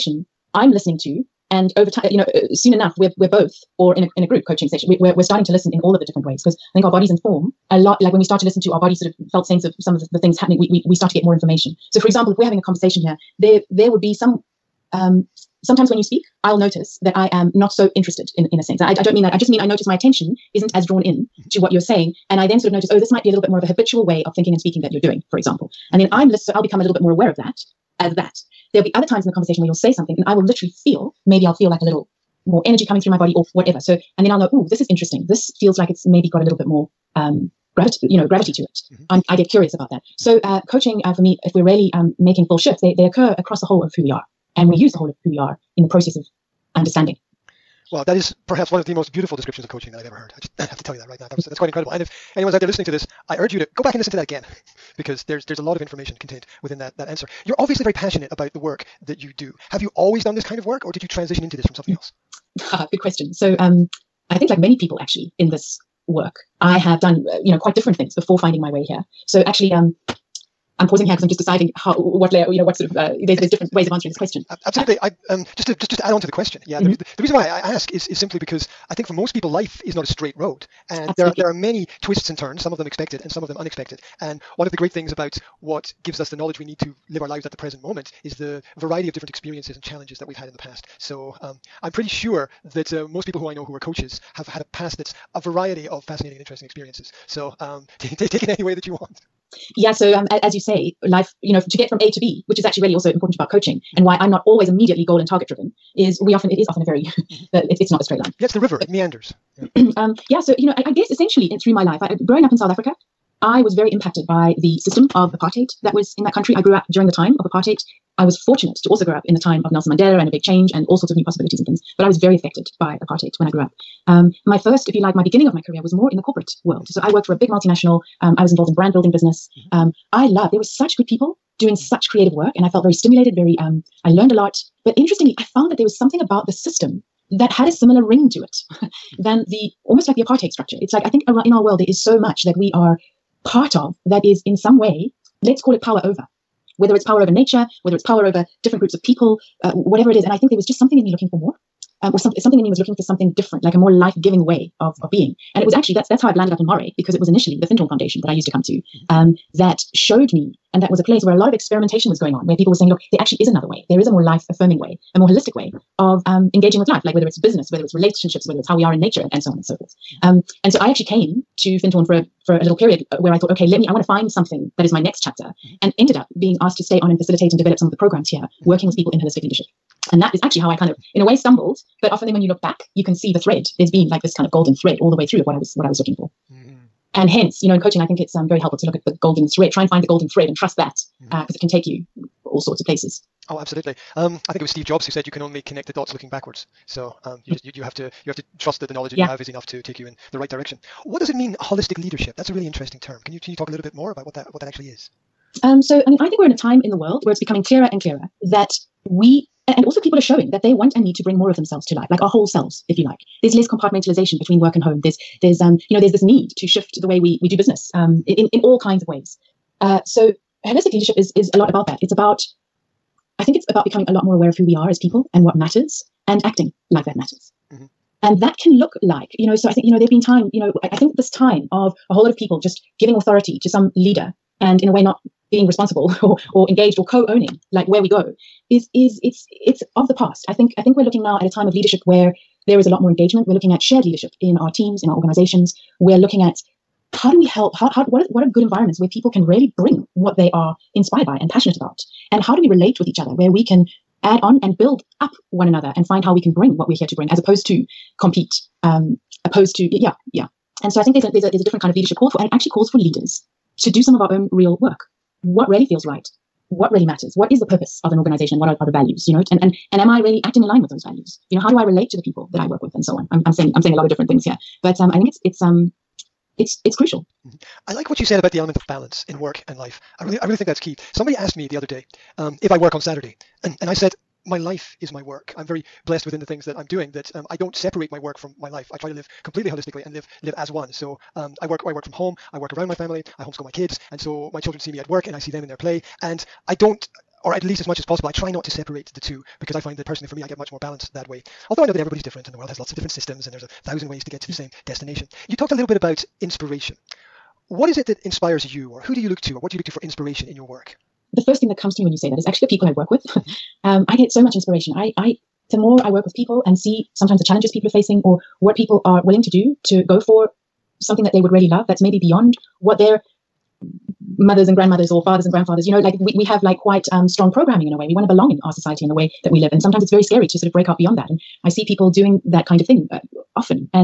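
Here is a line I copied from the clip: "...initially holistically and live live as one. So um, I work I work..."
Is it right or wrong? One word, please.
wrong.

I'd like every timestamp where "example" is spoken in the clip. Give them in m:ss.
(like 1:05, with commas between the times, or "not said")
0:12, 0:25.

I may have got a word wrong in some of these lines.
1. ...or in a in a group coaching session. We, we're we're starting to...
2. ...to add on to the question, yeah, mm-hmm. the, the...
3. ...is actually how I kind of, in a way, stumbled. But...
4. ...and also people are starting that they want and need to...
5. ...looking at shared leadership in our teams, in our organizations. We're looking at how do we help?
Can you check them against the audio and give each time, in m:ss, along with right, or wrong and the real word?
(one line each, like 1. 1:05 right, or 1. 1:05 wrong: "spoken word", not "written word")
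1. 0:03 right
2. 1:15 right
3. 3:00 right
4. 3:29 wrong: "showing", not "starting"
5. 4:03 right.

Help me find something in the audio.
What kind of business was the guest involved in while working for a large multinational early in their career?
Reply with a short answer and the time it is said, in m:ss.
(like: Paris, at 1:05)
Brand building, at 2:08.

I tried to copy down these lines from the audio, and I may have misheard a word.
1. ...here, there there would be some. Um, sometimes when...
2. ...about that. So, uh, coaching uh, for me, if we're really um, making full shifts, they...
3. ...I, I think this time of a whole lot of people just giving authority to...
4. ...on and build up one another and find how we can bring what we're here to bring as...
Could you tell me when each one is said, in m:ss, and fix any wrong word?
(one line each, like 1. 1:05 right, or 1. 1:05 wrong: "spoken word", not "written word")
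1. 0:12 right
2. 0:39 right
3. 3:50 right
4. 4:14 right.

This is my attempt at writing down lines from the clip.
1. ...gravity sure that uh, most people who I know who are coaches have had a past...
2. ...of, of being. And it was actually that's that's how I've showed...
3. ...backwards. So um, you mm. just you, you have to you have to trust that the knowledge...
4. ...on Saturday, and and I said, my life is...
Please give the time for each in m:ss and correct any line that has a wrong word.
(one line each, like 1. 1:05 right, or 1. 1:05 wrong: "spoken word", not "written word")
1. 1:31 wrong: "pretty", not "gravity"
2. 2:34 wrong: "landed", not "showed"
3. 3:16 right
4. 4:42 right.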